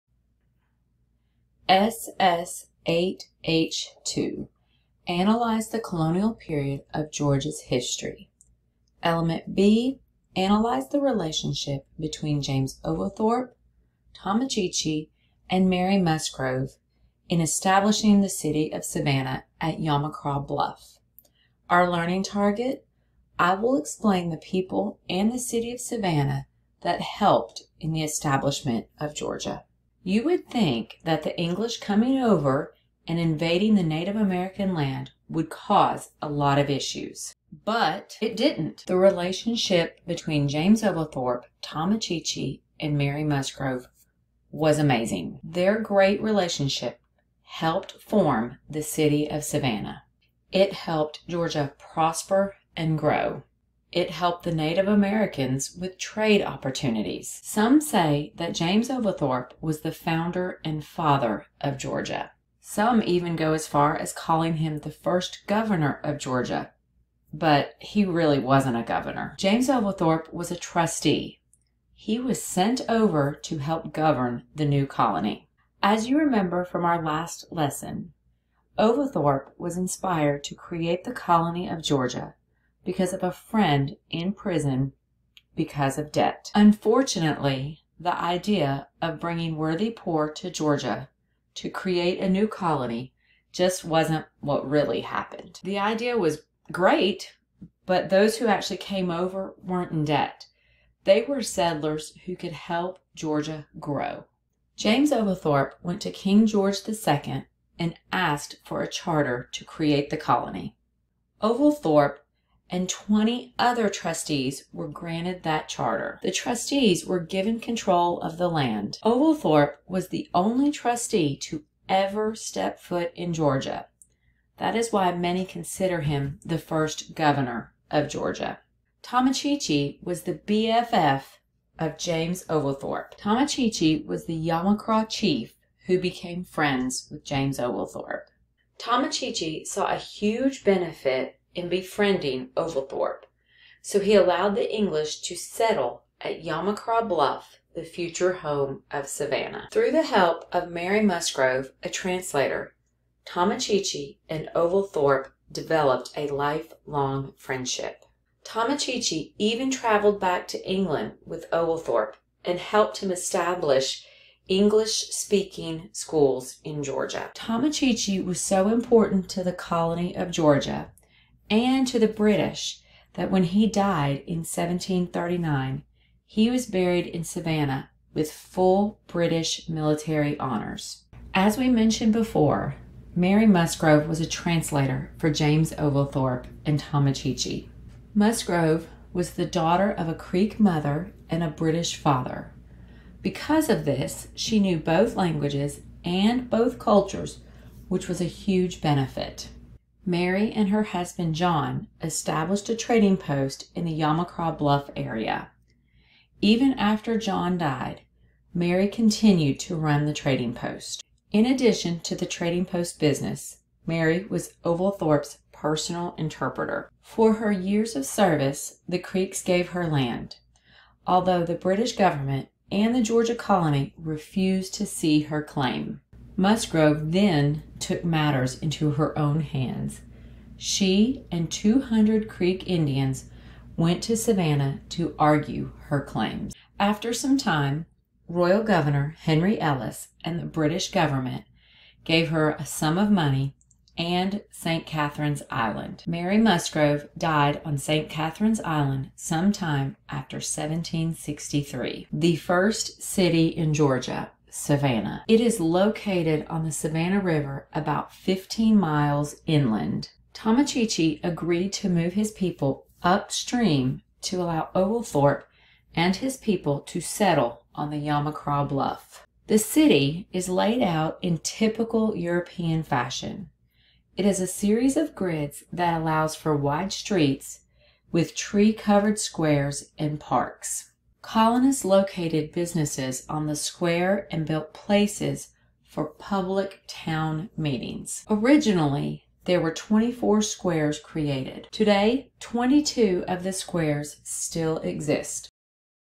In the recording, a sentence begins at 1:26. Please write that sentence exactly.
Unfortunately, the idea of bringing worthy poor to Georgia to create a new colony just wasn't what really happened.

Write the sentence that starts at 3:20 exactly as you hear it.
Mary and her husband John established a trading post in the Yamacraw Bluff area.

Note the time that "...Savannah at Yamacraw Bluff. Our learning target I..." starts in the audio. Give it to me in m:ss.
0:18.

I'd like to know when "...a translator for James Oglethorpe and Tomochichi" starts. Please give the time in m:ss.
3:04.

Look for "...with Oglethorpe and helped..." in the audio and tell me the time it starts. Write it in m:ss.
2:41.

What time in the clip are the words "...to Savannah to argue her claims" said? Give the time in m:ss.
3:54.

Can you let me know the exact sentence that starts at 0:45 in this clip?
Their great relationship helped form the city of Savannah.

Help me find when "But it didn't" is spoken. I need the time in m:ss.
0:37.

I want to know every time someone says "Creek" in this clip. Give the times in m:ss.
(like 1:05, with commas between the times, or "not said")
3:10, 3:38, 3:52.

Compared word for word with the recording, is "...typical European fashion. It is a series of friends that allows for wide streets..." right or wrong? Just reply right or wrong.
wrong.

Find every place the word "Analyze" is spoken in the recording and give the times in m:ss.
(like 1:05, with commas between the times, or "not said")
0:05, 0:10.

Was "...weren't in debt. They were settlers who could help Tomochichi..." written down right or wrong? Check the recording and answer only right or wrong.
wrong.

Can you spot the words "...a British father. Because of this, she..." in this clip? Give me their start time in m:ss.
3:11.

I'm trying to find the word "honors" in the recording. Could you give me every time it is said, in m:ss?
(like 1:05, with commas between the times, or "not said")
3:00.